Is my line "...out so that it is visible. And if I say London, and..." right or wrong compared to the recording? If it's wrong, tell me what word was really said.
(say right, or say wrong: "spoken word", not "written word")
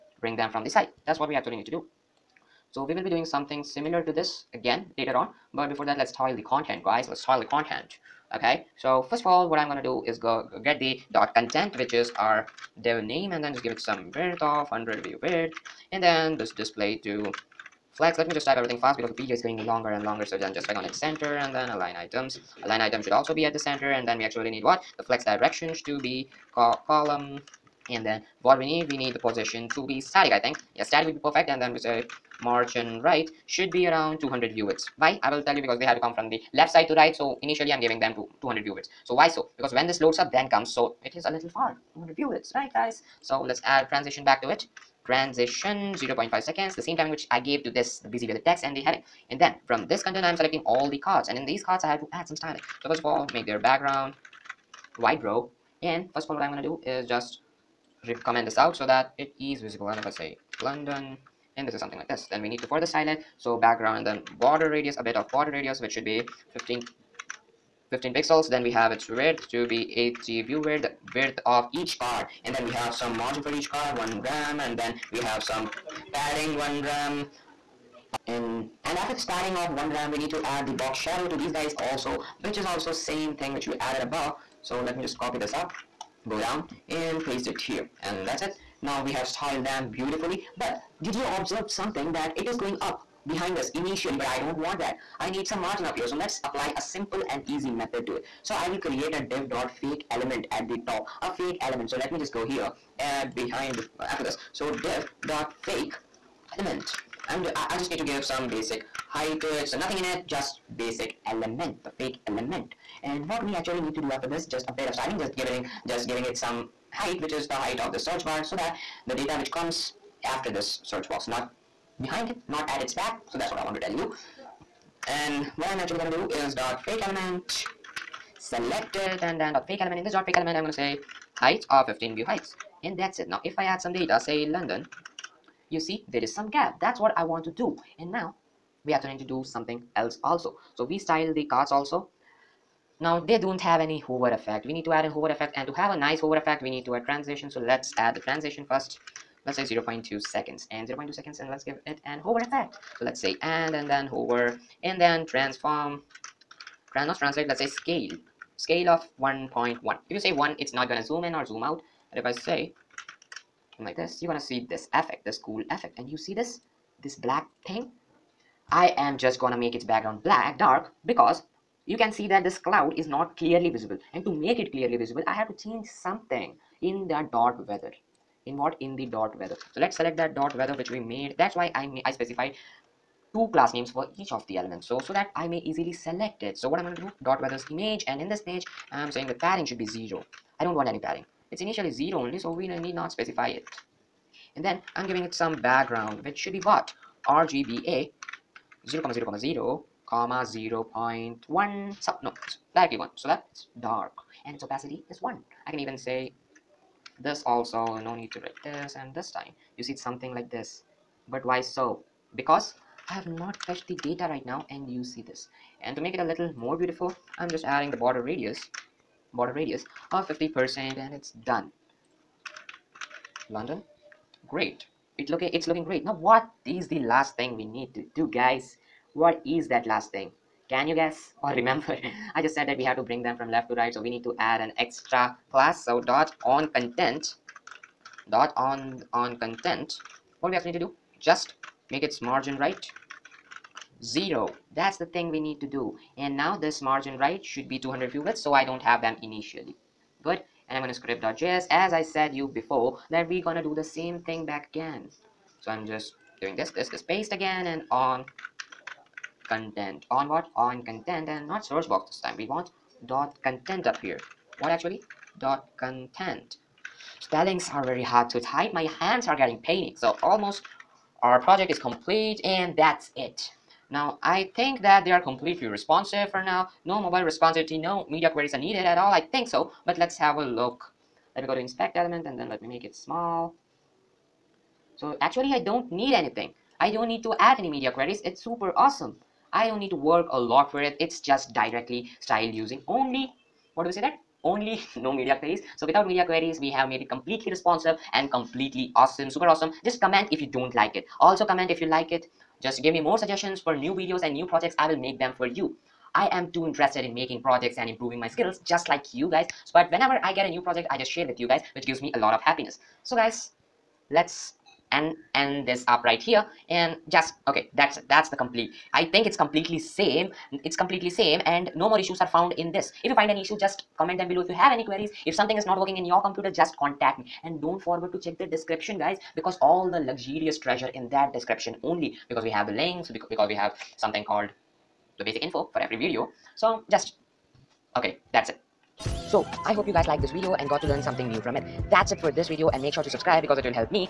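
right.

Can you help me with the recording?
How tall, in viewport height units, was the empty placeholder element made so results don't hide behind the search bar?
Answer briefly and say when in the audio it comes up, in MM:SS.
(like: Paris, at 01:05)
15 vh, at 02:11.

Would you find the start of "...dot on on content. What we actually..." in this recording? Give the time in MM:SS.
03:58.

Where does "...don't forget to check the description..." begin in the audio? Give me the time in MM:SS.
05:27.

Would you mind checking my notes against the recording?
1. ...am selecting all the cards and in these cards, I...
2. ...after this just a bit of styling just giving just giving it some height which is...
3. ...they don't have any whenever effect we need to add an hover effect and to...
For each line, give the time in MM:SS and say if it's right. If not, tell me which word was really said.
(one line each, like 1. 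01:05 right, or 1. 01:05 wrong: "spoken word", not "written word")
1. 00:50 right
2. 01:54 right
3. 02:23 wrong: "hover", not "whenever".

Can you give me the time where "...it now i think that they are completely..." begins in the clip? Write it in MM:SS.
04:33.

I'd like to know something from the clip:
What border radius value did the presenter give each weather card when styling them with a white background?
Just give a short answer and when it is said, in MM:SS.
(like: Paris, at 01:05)
15 pixels, at 01:07.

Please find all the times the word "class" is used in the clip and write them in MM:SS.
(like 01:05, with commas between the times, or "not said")
03:03, 03:55.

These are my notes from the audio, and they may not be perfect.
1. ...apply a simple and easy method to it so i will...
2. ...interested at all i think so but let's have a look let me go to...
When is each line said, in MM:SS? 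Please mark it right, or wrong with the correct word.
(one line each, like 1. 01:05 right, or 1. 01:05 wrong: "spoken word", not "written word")
1. 01:36 right
2. 04:38 wrong: "needed", not "interested".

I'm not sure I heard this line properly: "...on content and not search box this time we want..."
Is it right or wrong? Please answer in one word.
right.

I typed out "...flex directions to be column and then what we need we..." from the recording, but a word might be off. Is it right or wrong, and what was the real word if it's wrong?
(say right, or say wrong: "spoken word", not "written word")
right.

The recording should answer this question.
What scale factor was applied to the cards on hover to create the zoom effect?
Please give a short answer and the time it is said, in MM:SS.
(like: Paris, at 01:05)
1.1, at 02:39.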